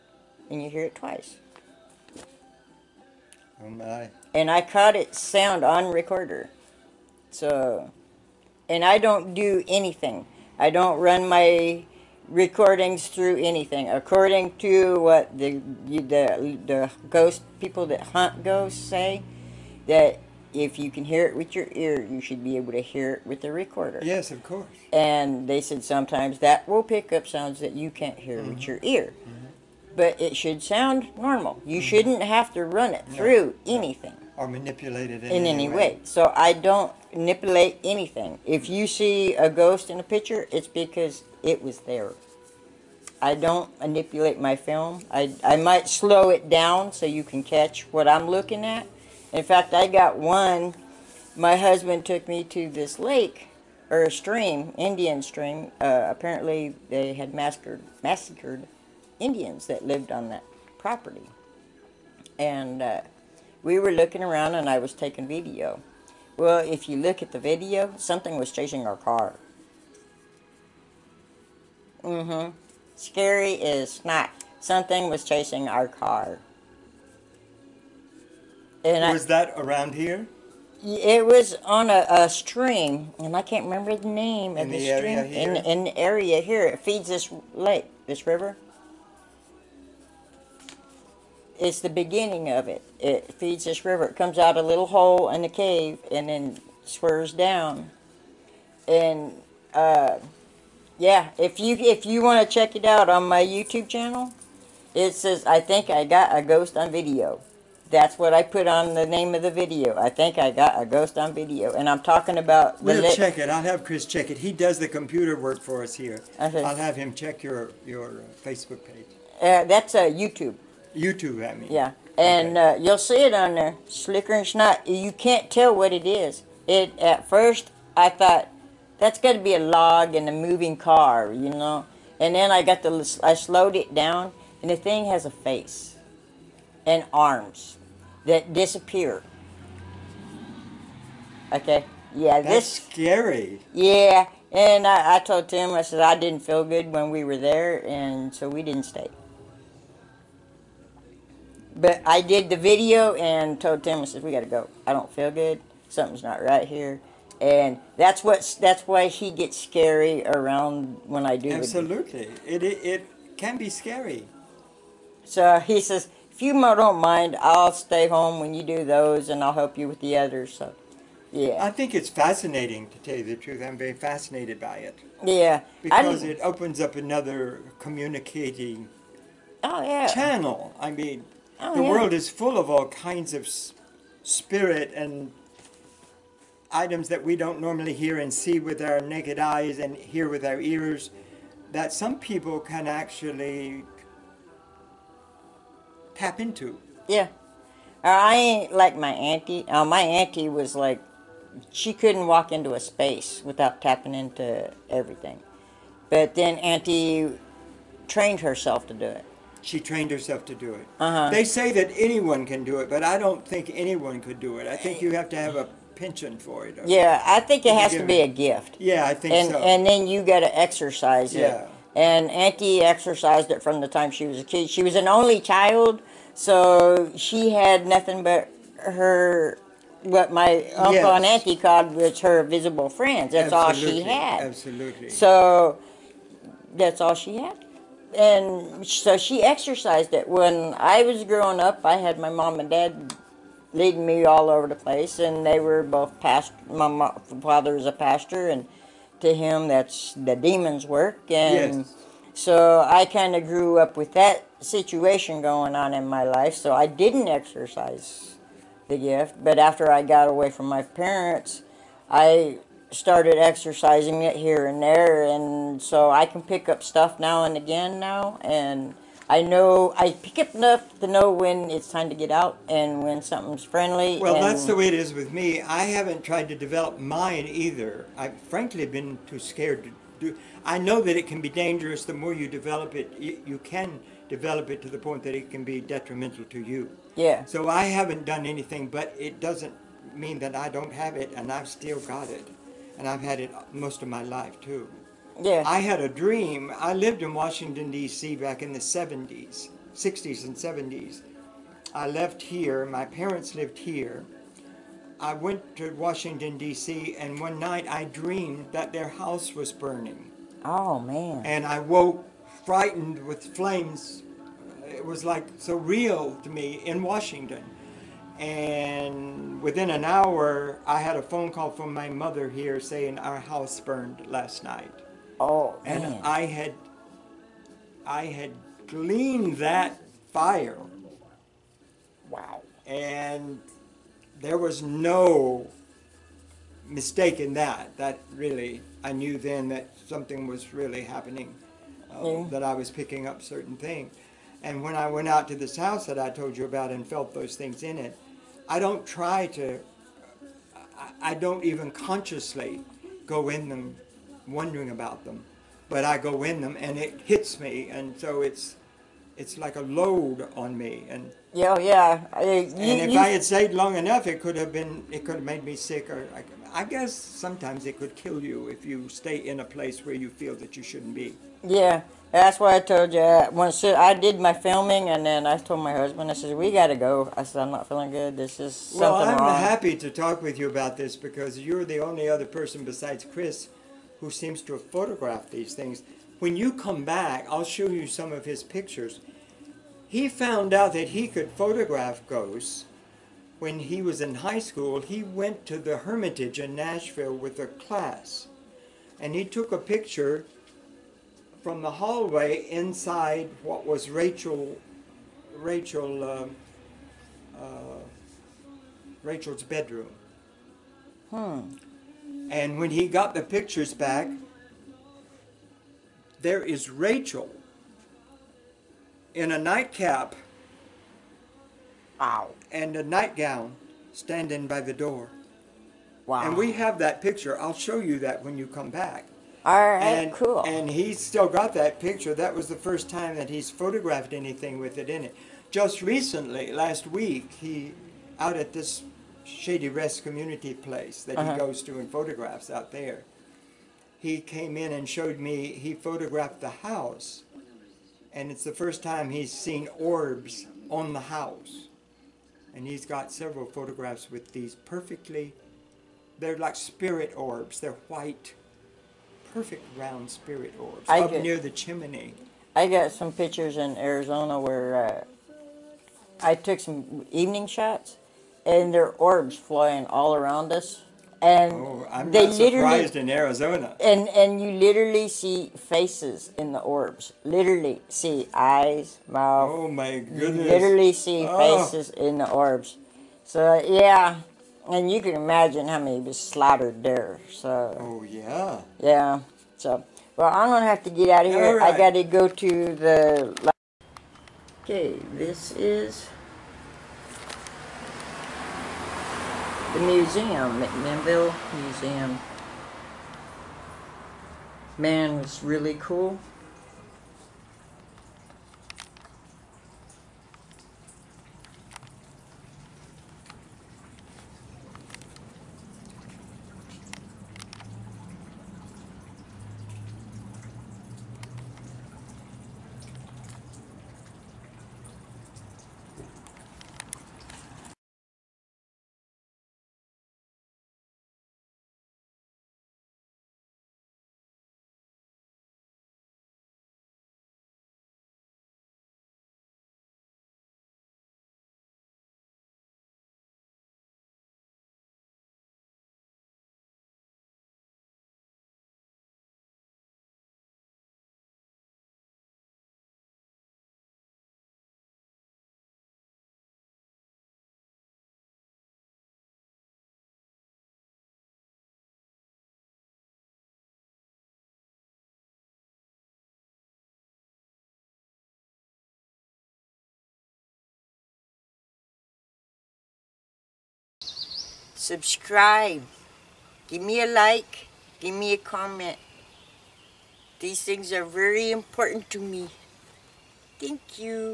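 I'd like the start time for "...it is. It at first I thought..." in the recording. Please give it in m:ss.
2:05.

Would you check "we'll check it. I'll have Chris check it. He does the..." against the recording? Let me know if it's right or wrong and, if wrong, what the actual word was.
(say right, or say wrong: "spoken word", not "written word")
right.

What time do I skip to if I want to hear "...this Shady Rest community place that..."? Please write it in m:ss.
7:18.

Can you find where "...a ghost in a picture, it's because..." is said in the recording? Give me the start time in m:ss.
0:39.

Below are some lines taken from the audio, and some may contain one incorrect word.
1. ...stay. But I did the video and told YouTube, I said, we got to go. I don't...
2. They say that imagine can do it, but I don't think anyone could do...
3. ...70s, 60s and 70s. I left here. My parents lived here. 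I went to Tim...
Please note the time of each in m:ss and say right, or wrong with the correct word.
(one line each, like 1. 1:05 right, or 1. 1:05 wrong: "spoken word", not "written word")
1. 2:28 wrong: "Tim", not "YouTube"
2. 3:31 wrong: "anyone", not "imagine"
3. 4:58 wrong: "Washington", not "Tim".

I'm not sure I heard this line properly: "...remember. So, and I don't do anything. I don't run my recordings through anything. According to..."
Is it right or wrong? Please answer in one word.
wrong.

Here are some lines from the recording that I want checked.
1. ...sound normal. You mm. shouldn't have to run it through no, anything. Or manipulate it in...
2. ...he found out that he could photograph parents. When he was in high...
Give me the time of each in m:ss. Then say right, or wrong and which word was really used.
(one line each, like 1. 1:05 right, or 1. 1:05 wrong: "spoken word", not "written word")
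1. 0:30 right
2. 6:30 wrong: "ghosts", not "parents".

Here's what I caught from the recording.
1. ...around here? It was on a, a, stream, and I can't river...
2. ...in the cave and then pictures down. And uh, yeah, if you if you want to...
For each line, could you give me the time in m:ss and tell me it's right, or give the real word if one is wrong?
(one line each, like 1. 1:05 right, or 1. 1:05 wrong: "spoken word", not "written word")
1. 1:19 wrong: "remember", not "river"
2. 1:35 wrong: "swerves", not "pictures".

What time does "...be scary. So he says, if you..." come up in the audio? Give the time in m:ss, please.
2:43.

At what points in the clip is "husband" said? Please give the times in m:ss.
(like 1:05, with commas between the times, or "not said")
0:51, 6:15.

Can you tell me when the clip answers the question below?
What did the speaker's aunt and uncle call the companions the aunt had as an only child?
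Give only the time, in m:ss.
3:52.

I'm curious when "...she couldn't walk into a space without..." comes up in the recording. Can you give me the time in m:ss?
3:21.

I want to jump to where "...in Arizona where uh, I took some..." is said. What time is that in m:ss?
7:43.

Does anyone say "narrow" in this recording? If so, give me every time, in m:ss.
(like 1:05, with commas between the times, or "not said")
not said.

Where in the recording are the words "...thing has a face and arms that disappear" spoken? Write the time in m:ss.
2:14.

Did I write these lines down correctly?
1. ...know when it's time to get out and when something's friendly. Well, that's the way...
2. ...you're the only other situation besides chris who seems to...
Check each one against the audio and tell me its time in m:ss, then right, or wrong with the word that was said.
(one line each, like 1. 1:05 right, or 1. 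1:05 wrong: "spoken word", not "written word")
1. 4:31 right
2. 6:21 wrong: "person", not "situation".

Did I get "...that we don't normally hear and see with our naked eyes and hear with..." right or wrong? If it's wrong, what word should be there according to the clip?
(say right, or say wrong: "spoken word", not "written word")
right.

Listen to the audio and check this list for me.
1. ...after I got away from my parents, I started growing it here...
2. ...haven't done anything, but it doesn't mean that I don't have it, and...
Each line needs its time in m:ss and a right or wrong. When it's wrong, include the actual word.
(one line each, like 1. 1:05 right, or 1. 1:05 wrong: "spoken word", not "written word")
1. 4:19 wrong: "exercising", not "growing"
2. 4:47 right.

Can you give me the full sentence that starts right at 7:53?
And and you literally see faces in the orbs.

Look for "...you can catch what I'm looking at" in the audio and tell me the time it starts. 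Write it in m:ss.
0:47.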